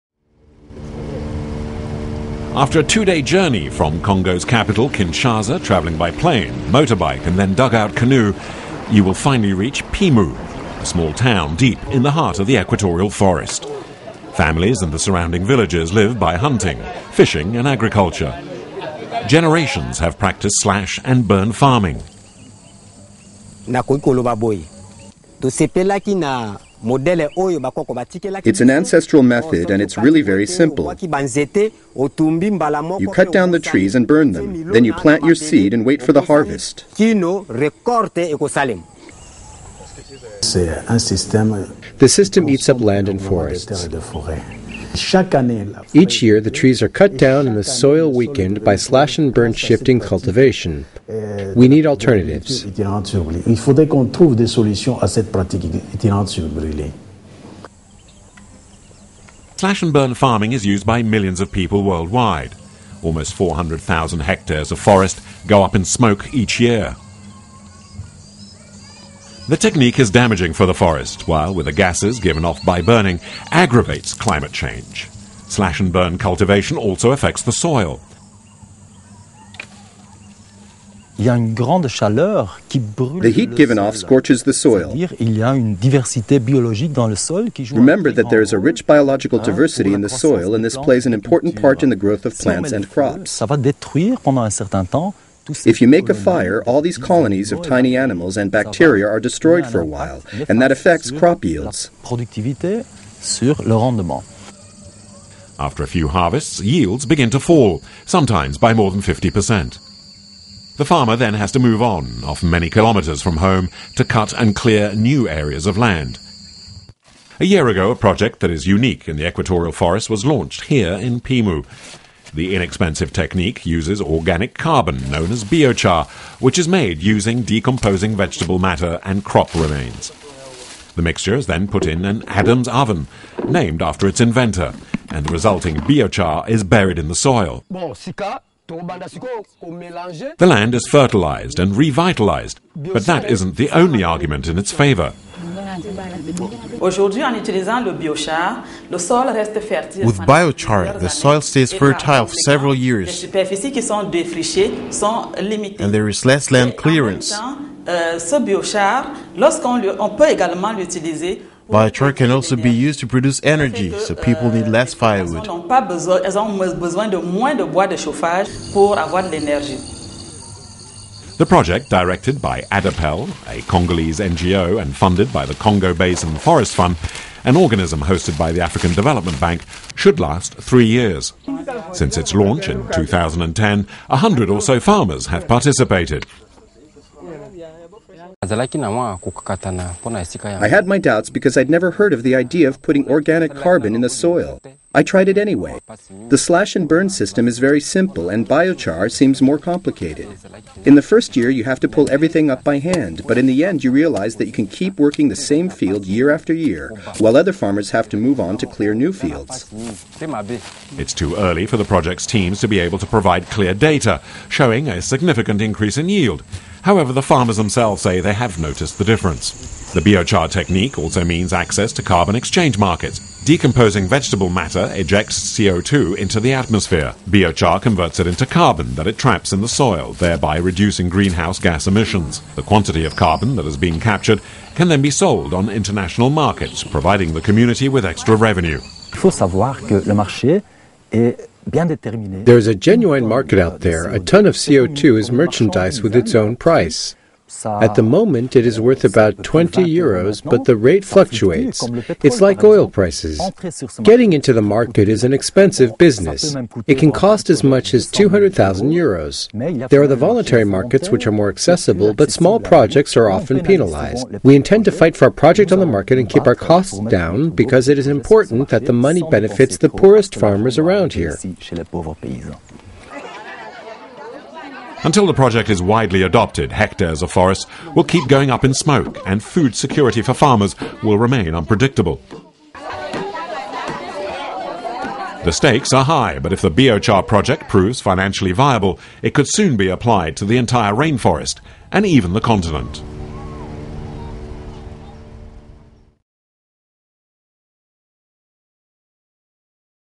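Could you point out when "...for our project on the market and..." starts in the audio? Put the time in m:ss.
4:25.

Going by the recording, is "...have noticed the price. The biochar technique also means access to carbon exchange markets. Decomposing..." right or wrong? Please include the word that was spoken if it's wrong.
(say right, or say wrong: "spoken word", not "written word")
wrong: "difference", not "price".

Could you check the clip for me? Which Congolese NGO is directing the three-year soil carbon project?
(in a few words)
ADAPEL.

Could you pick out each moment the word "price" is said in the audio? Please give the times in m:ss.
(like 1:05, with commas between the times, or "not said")
4:06, 4:12.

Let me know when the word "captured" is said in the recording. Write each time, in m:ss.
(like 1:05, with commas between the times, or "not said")
3:53.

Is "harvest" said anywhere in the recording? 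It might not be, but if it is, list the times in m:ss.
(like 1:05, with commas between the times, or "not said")
0:36, 1:46.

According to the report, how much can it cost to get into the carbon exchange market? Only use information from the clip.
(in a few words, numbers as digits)
200,000 euros.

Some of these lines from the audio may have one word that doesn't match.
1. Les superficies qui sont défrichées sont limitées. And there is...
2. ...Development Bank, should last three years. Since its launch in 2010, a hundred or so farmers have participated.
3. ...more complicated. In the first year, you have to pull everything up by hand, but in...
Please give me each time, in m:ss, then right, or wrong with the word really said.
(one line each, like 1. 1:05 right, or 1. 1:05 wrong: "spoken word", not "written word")
1. 2:33 right
2. 2:58 right
3. 3:19 right.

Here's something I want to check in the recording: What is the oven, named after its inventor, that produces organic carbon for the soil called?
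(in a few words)
Adam's oven.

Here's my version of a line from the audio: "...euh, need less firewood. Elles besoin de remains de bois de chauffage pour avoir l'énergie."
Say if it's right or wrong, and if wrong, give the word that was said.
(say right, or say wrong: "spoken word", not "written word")
wrong: "moins", not "remains".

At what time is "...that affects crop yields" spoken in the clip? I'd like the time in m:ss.
1:40.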